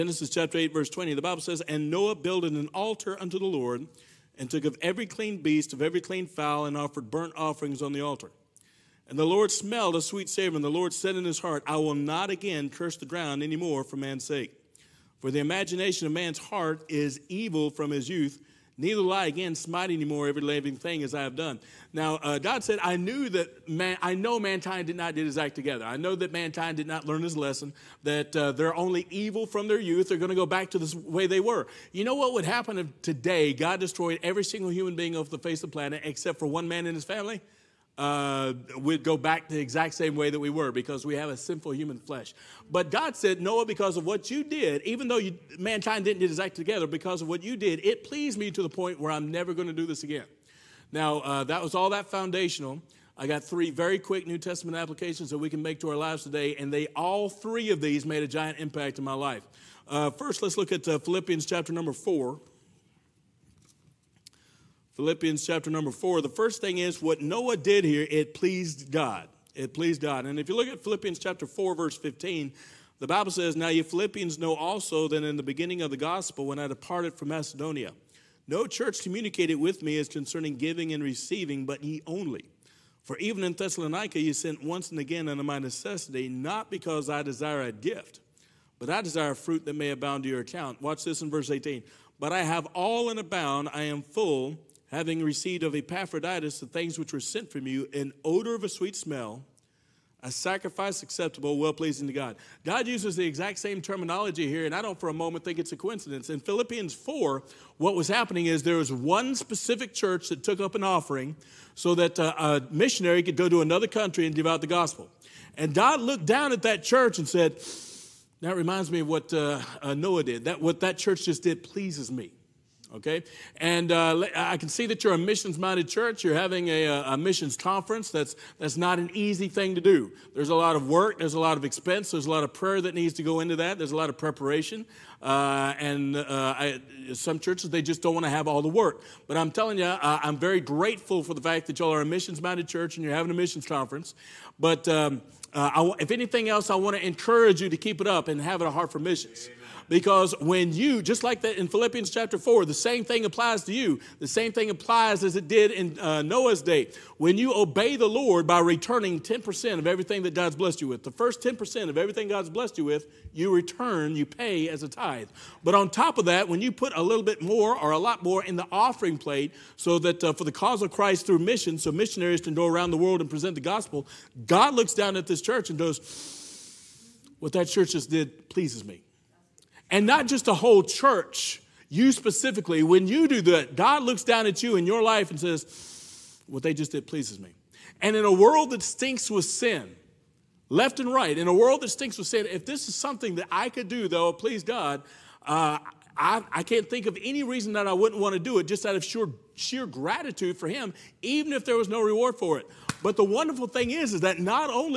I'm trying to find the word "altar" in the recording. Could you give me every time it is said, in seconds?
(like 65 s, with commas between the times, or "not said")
2 s, 7 s.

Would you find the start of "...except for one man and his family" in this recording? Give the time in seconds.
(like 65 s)
36 s.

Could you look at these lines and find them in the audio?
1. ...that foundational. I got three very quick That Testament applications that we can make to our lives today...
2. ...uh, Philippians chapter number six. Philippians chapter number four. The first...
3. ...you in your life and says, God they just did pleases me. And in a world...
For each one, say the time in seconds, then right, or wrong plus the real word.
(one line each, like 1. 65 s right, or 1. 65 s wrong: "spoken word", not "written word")
1. 51 s wrong: "New", not "That"
2. 60 s wrong: "four", not "six"
3. 184 s wrong: "What", not "God".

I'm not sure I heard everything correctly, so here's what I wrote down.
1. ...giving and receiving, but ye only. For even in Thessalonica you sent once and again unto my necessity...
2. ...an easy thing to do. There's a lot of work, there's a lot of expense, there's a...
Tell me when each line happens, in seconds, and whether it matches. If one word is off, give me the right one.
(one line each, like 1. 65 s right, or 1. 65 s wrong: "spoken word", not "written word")
1. 80 s right
2. 128 s right.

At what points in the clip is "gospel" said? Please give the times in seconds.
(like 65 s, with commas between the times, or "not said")
75 s, 114 s, 173 s.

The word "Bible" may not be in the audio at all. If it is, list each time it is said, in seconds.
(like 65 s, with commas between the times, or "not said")
1 s, 73 s.